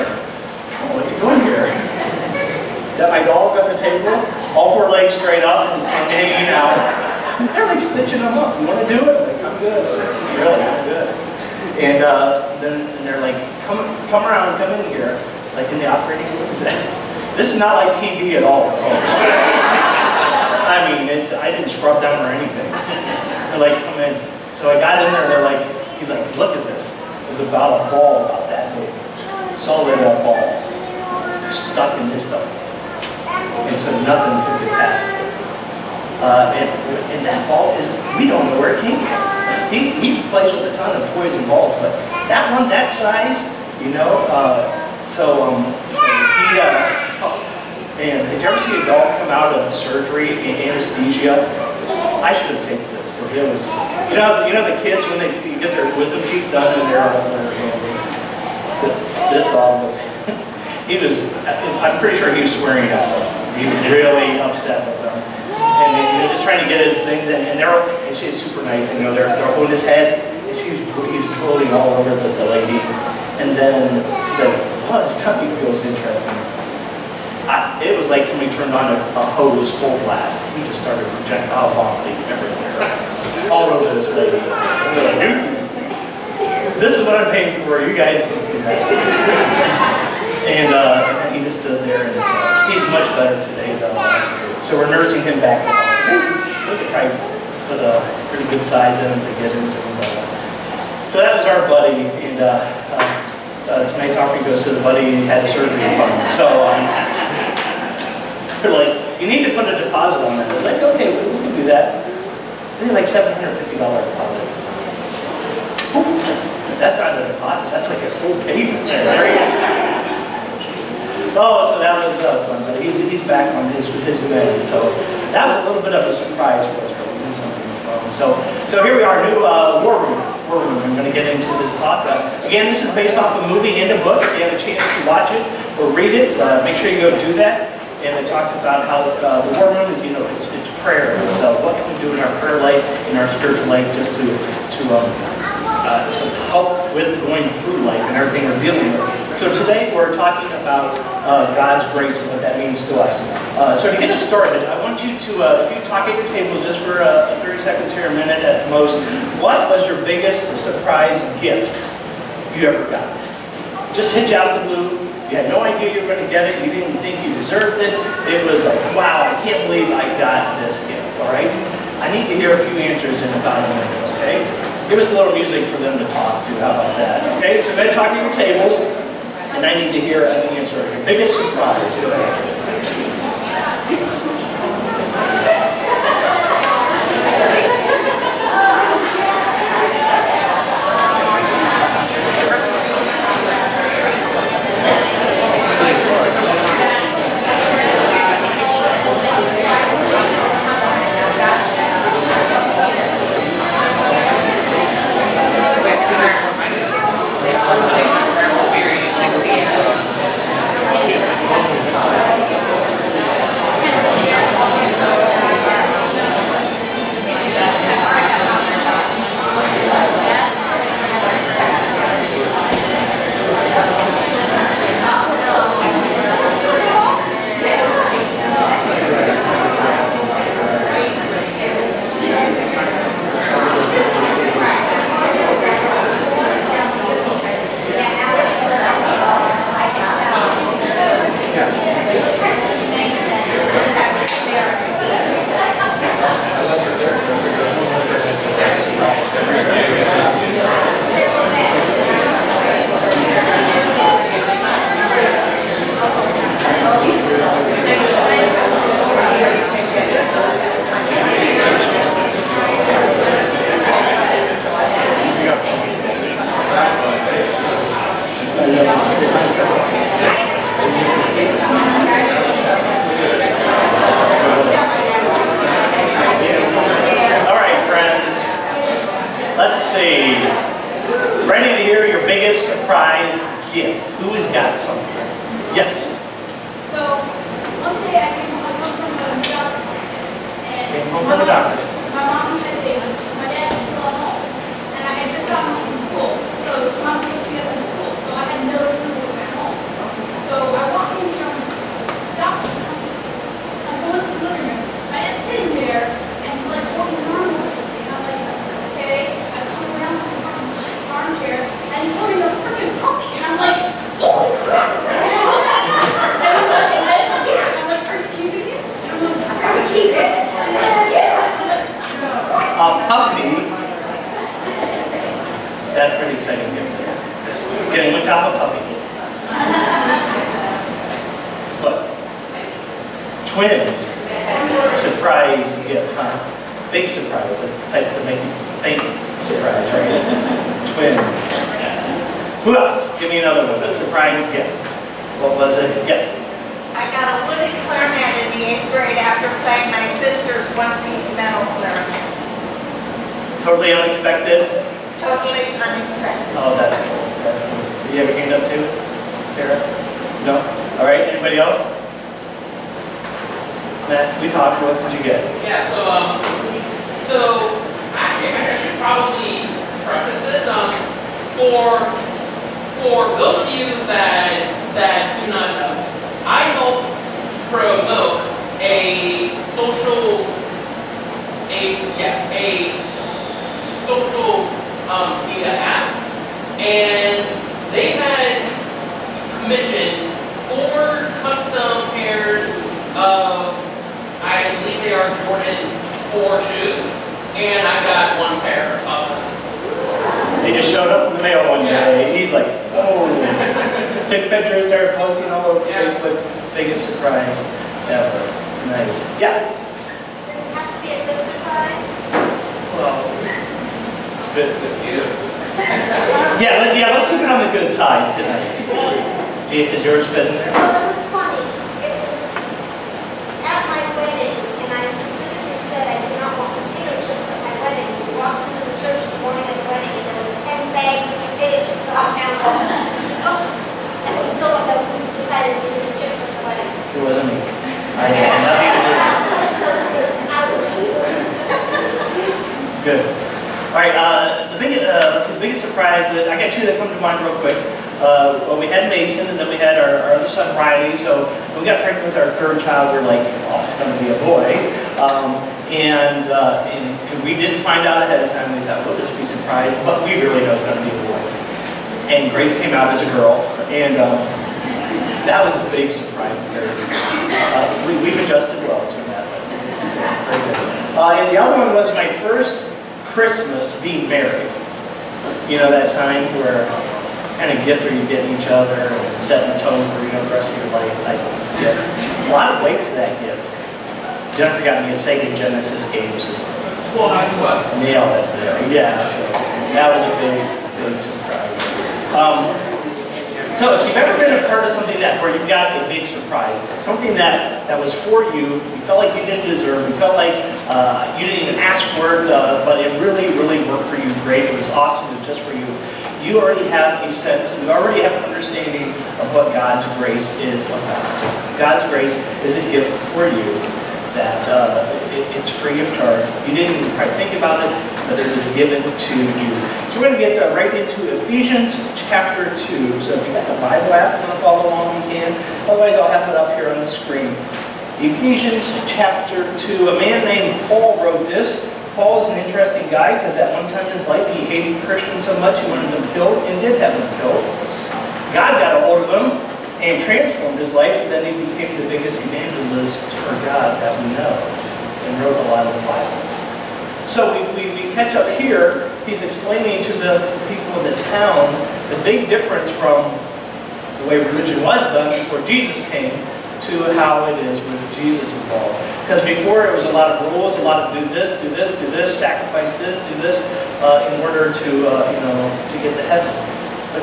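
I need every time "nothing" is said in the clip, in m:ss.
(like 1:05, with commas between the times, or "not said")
0:34, 7:18.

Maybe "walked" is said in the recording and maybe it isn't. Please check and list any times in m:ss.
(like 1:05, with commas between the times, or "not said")
7:08.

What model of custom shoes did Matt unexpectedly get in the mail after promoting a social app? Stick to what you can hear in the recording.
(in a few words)
Jordan 4.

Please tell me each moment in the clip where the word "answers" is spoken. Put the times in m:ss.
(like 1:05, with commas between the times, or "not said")
2:52, 3:00.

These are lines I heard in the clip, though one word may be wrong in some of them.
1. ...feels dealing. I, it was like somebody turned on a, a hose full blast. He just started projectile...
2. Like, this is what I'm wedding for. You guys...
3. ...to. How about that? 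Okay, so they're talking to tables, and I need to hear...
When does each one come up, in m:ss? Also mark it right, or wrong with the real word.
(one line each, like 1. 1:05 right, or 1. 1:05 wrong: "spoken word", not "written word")
1. 1:15 wrong: "interesting", not "dealing"
2. 1:24 wrong: "paying", not "wedding"
3. 2:56 right.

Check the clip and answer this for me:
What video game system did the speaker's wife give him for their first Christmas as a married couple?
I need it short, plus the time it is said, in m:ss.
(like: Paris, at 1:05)
Sega Genesis, at 8:05.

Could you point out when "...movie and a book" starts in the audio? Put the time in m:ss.
2:13.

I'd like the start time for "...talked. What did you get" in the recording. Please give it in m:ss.
6:04.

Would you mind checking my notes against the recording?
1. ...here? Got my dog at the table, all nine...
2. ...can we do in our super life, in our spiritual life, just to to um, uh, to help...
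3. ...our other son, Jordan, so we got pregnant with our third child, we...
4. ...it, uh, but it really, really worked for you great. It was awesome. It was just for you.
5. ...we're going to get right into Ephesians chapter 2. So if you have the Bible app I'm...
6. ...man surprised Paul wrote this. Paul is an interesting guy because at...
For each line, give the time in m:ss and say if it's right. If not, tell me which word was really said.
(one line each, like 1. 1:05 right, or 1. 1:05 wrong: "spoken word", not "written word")
1. 0:01 wrong: "four", not "nine"
2. 2:21 wrong: "prayer", not "super"
3. 7:30 wrong: "Riley", not "Jordan"
4. 8:22 right
5. 8:40 right
6. 8:50 wrong: "named", not "surprised".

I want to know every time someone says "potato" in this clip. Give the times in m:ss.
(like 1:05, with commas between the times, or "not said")
7:06, 7:11.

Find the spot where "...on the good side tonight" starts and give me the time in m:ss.
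6:57.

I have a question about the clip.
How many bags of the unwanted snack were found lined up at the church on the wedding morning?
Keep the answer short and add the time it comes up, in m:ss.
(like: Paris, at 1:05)
10, at 7:10.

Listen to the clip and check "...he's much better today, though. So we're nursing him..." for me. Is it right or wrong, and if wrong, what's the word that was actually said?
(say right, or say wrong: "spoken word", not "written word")
right.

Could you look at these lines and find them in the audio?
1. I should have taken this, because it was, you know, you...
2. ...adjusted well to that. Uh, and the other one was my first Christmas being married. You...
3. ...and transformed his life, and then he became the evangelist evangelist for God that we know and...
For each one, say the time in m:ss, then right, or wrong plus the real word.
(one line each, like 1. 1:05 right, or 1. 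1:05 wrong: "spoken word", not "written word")
1. 0:52 right
2. 7:48 right
3. 8:59 wrong: "biggest", not "evangelist".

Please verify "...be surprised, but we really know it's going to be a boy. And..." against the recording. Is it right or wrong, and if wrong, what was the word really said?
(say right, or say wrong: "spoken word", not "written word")
right.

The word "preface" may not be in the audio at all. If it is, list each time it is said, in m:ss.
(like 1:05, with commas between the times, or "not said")
6:10.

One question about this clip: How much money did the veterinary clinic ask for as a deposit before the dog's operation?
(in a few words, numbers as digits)
$750.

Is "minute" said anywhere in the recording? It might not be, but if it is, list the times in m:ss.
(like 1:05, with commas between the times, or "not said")
2:38, 2:53.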